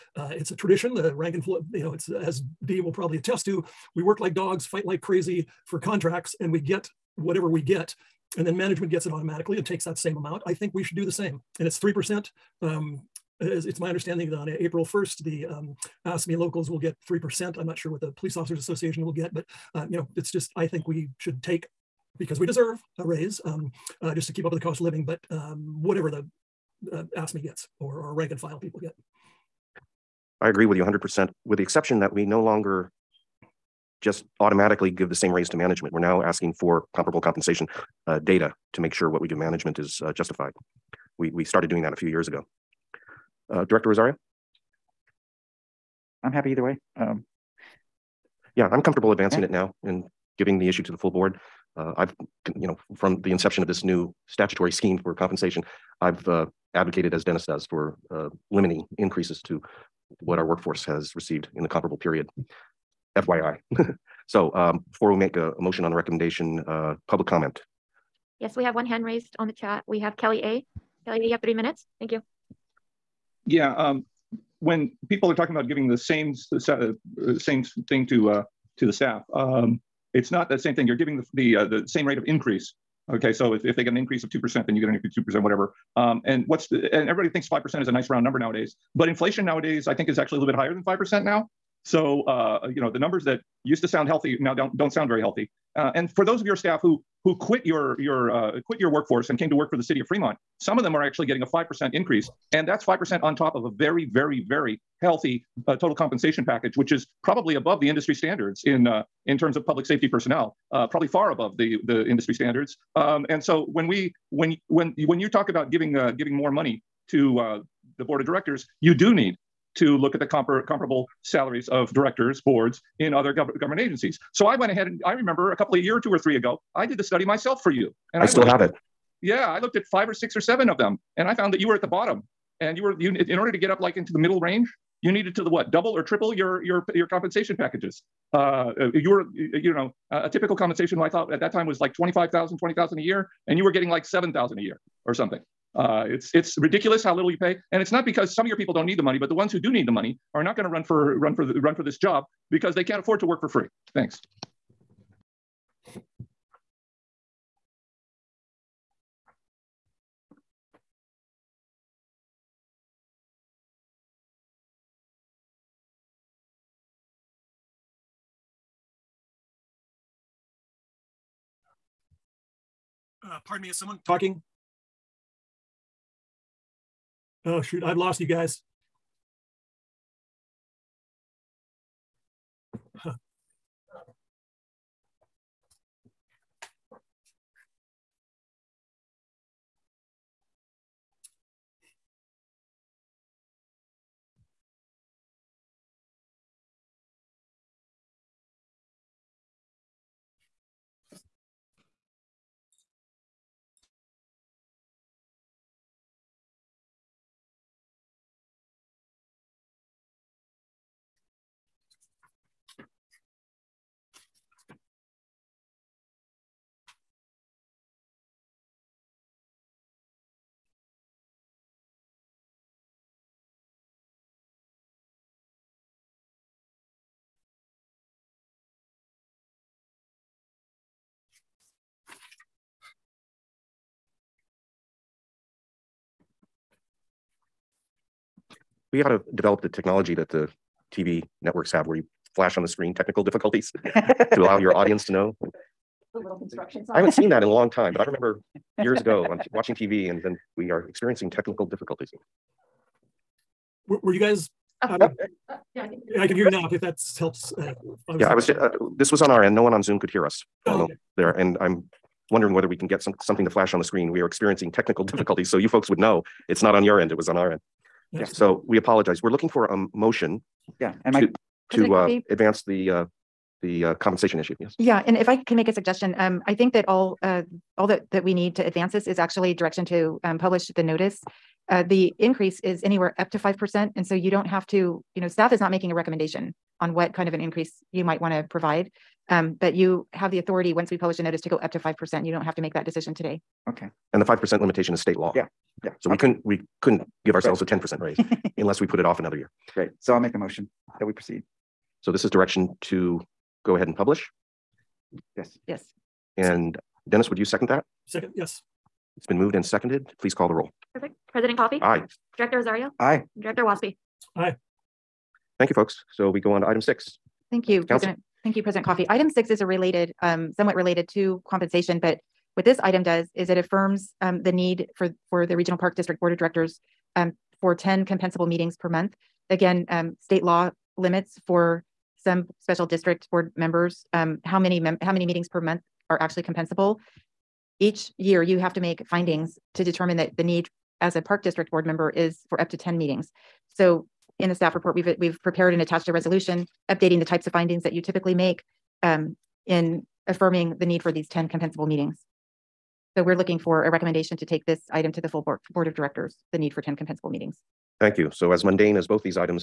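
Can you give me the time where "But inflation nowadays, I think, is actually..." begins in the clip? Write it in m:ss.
1:28.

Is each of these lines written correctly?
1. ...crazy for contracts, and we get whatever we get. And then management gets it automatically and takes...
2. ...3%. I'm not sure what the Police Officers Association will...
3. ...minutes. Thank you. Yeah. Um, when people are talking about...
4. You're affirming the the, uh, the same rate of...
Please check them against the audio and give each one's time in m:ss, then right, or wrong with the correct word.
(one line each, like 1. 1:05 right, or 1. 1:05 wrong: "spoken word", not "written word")
1. 0:05 right
2. 0:17 right
3. 1:11 right
4. 1:20 wrong: "giving", not "affirming".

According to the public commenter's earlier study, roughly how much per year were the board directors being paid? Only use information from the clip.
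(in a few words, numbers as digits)
7000.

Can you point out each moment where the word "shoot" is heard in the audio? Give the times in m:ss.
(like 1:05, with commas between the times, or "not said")
2:57.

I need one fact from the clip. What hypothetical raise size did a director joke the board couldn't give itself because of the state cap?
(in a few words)
10%.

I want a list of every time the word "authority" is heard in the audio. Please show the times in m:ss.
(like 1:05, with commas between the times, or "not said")
4:50.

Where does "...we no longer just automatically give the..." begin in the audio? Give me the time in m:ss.
0:32.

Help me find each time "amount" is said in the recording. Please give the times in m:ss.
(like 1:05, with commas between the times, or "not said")
0:10.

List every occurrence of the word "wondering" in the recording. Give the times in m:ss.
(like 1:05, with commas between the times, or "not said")
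4:22.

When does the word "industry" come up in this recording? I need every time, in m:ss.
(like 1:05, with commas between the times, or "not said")
1:47, 1:52.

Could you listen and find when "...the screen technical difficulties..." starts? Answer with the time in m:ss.
4:02.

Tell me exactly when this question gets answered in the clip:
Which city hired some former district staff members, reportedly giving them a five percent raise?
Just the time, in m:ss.
1:39.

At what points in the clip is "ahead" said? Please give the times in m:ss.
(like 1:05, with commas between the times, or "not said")
2:04, 5:03.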